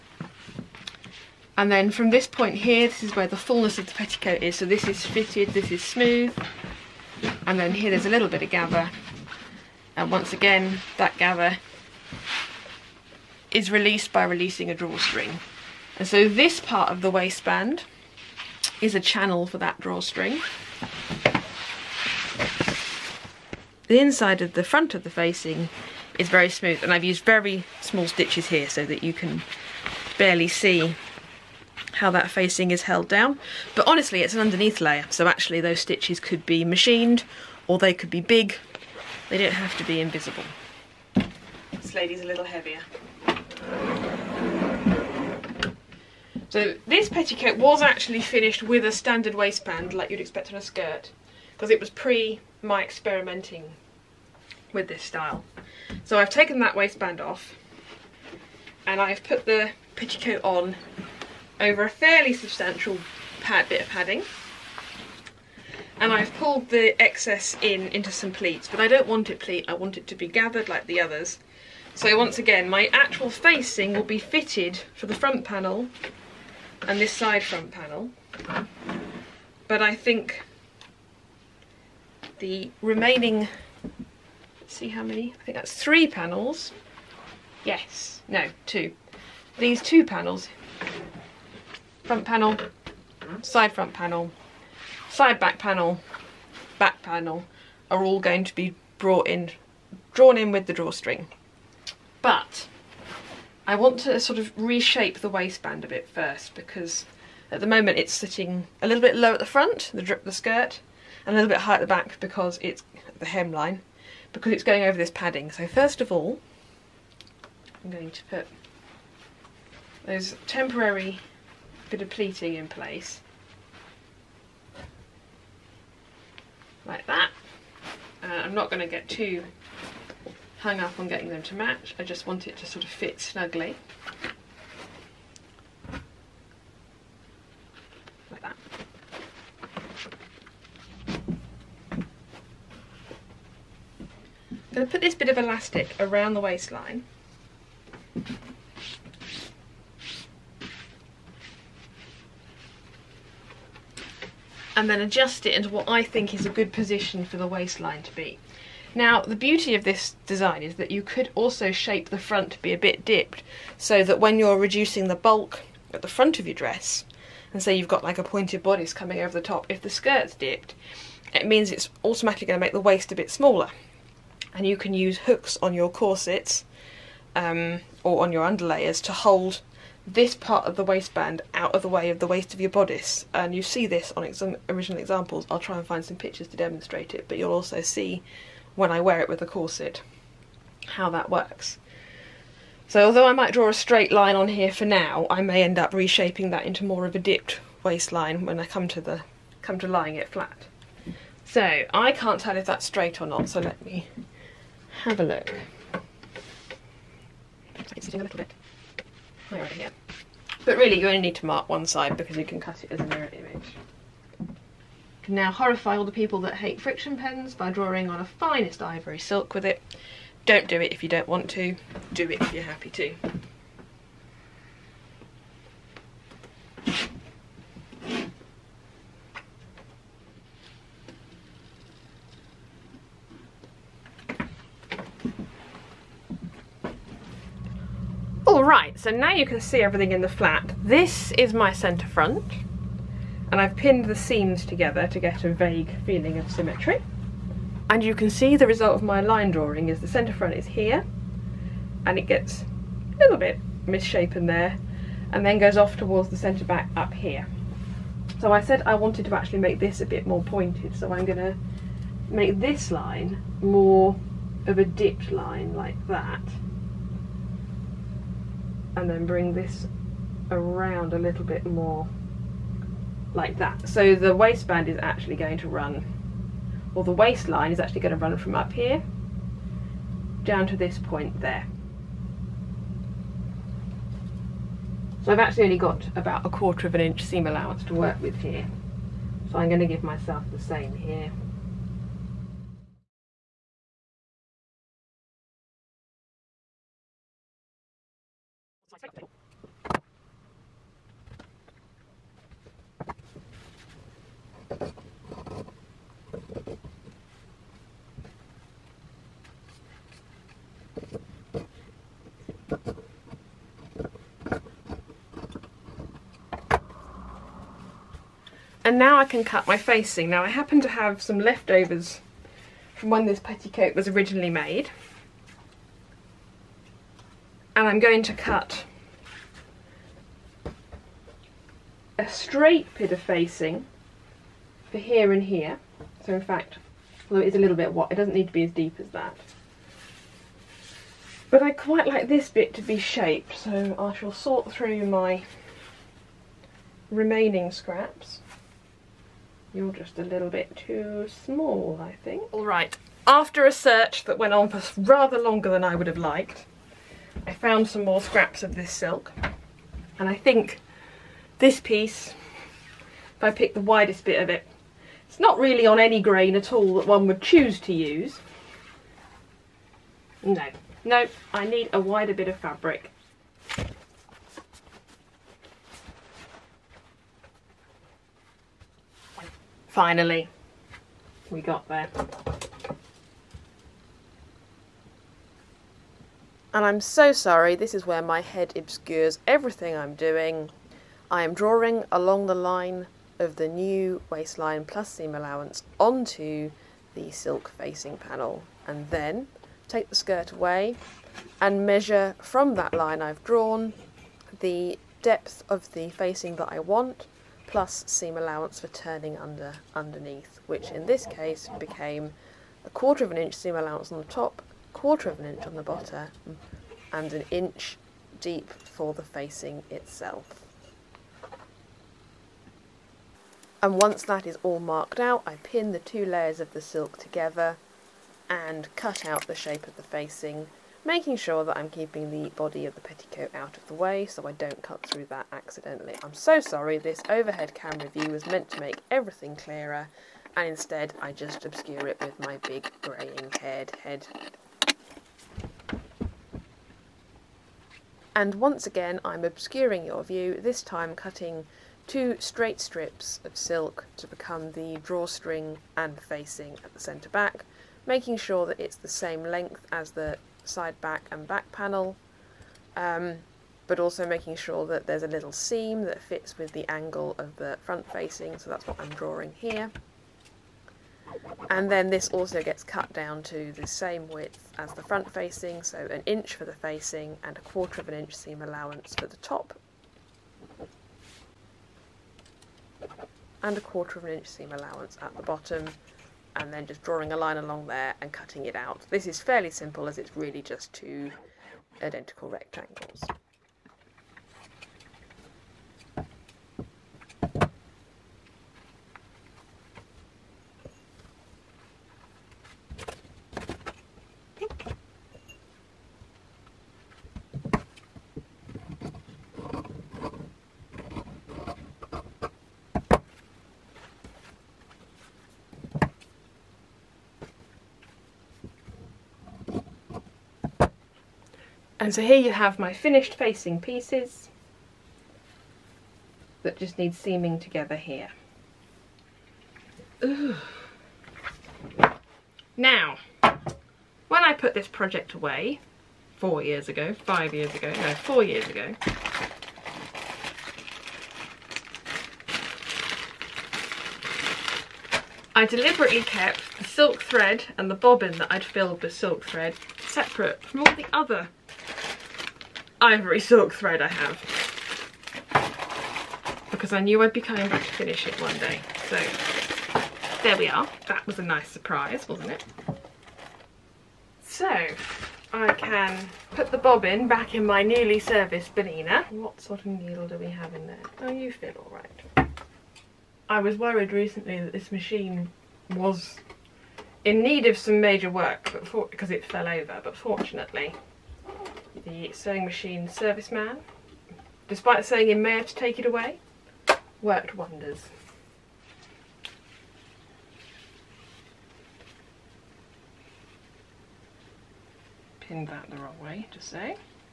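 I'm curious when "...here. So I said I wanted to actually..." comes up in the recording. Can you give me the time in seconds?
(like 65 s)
257 s.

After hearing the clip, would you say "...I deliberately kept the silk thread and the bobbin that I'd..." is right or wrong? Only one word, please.
right.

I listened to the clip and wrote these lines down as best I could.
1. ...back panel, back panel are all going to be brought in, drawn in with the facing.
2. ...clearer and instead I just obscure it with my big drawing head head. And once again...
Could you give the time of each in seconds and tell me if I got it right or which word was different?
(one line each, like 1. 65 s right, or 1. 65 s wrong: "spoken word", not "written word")
1. 95 s wrong: "drawstring", not "facing"
2. 439 s wrong: "greying", not "drawing".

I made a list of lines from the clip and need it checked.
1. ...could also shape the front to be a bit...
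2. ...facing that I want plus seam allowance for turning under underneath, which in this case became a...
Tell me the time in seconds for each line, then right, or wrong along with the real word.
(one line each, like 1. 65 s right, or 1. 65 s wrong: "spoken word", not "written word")
1. 161 s right
2. 406 s right.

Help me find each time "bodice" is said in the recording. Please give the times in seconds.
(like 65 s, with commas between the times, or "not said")
168 s, 182 s.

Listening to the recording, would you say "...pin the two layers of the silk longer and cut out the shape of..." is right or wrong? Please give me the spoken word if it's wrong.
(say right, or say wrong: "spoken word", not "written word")
wrong: "together", not "longer".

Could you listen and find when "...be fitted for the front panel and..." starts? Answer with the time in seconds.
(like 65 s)
74 s.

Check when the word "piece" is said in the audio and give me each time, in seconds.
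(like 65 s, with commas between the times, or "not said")
361 s, 523 s.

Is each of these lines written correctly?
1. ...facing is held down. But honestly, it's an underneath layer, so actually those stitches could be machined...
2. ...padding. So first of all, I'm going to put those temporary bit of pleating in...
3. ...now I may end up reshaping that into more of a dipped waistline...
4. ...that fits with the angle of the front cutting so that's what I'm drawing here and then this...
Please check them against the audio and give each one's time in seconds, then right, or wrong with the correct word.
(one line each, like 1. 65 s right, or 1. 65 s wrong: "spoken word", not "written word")
1. 32 s right
2. 115 s right
3. 194 s right
4. 466 s wrong: "facing", not "cutting".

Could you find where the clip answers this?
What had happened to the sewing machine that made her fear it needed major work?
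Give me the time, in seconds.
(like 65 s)
579 s.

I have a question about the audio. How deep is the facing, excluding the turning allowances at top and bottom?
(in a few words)
1 inch.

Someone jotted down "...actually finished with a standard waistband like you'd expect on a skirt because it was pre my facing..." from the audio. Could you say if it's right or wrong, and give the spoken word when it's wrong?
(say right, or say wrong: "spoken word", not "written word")
wrong: "experimenting", not "facing".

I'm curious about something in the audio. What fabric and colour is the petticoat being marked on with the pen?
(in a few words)
Finest ivory silk.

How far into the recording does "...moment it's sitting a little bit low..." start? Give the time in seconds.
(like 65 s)
107 s.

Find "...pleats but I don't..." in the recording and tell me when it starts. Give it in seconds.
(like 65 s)
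68 s.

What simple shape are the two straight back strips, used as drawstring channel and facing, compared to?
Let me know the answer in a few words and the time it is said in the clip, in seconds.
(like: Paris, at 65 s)
Two identical rectangles, at 490 s.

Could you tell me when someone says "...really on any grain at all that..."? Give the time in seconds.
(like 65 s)
365 s.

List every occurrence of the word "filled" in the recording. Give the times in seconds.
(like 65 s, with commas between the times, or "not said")
548 s.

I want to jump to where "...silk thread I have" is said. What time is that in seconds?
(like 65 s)
553 s.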